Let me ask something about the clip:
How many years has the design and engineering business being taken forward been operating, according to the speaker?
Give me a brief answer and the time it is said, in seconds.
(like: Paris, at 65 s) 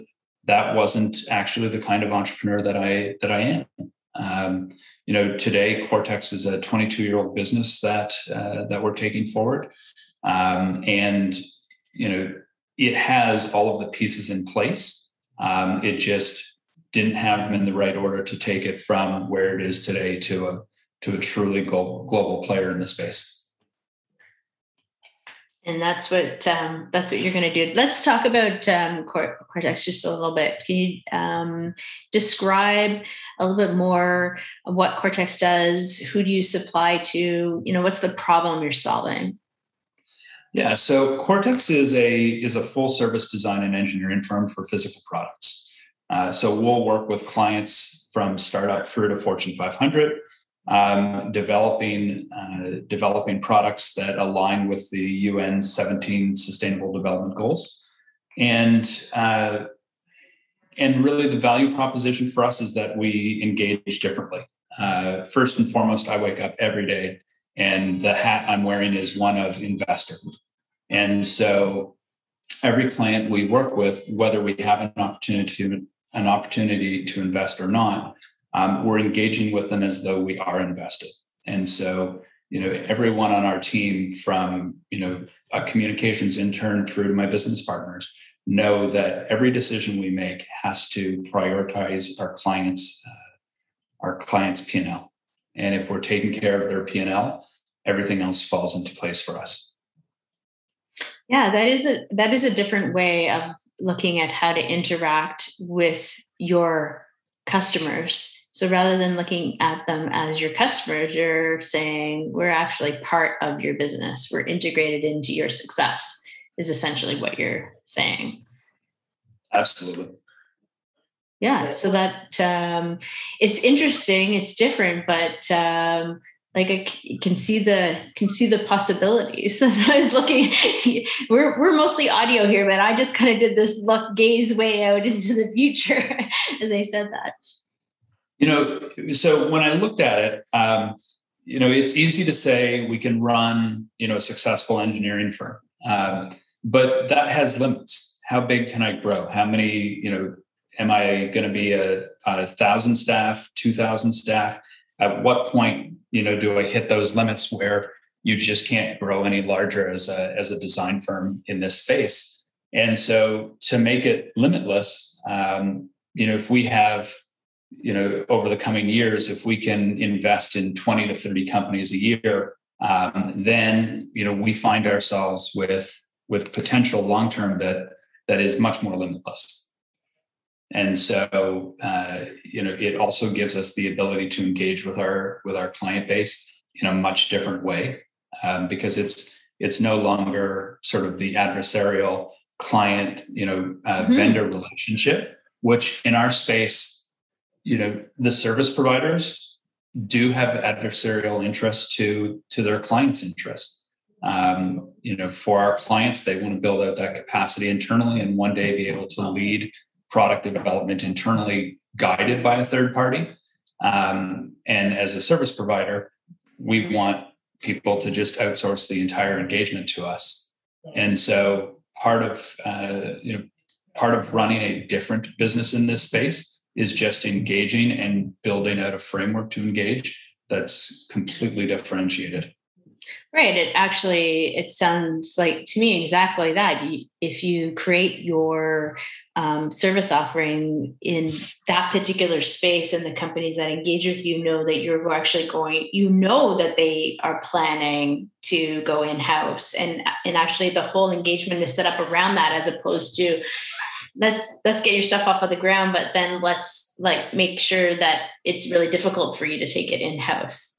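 22, at 6 s.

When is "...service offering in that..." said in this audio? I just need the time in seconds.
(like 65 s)
239 s.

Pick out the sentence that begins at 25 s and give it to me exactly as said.
And that's what um, that's what you're going to do.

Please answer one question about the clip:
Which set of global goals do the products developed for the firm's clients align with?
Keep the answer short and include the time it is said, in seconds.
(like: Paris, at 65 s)
UN 17 Sustainable Development Goals, at 55 s.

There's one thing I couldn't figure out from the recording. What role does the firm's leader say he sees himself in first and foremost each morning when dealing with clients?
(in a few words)
Investor.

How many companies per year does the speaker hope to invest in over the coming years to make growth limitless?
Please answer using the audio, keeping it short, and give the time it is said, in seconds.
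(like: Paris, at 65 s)
20 to 30, at 170 s.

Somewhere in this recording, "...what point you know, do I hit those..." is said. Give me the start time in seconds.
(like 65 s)
155 s.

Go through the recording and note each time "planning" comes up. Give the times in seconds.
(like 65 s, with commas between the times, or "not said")
247 s.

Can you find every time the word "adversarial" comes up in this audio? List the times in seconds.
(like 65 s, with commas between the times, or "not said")
191 s, 200 s.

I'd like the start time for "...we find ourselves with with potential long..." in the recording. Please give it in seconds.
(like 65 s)
174 s.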